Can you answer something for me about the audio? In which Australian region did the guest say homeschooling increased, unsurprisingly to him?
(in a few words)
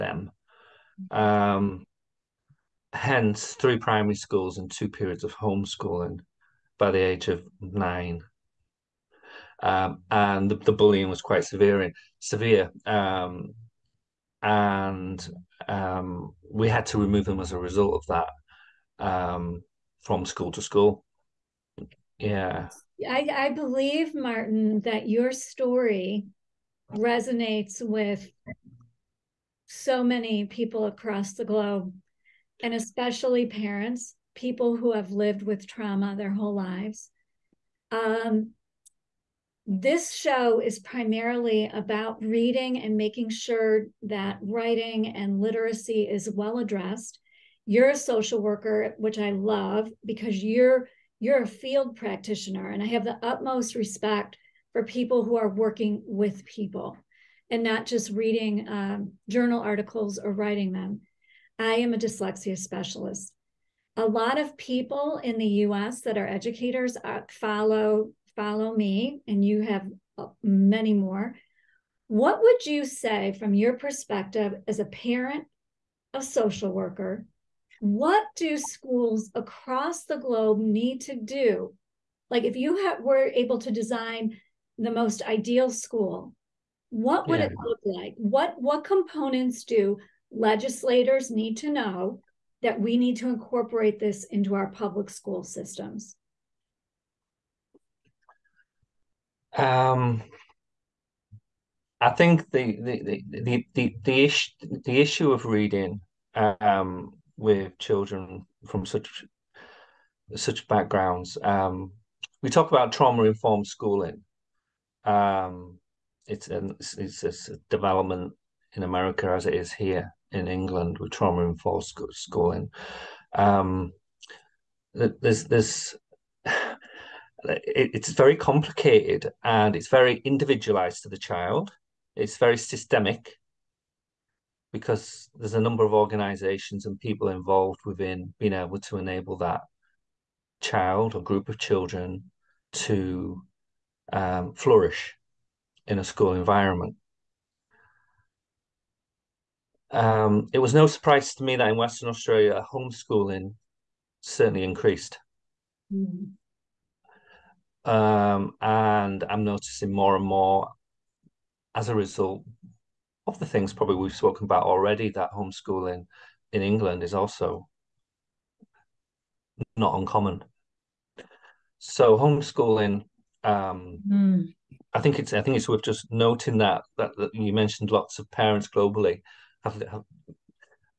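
Western Australia.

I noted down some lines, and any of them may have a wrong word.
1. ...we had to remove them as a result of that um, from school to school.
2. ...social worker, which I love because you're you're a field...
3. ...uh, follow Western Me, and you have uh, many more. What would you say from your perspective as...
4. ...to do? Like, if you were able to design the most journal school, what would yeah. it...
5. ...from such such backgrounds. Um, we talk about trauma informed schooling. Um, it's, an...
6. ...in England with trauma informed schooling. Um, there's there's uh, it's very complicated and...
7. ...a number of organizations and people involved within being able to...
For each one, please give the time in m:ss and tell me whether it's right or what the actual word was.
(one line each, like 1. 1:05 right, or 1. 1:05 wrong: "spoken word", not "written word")
1. 0:16 right
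2. 0:47 right
3. 1:07 wrong: "Follow", not "Western"
4. 1:21 wrong: "ideal", not "journal"
5. 1:48 right
6. 2:00 right
7. 2:15 right.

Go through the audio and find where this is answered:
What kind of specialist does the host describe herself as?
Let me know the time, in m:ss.
1:01.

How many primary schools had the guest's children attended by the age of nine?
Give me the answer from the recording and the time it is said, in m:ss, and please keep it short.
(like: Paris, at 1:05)
3, at 0:03.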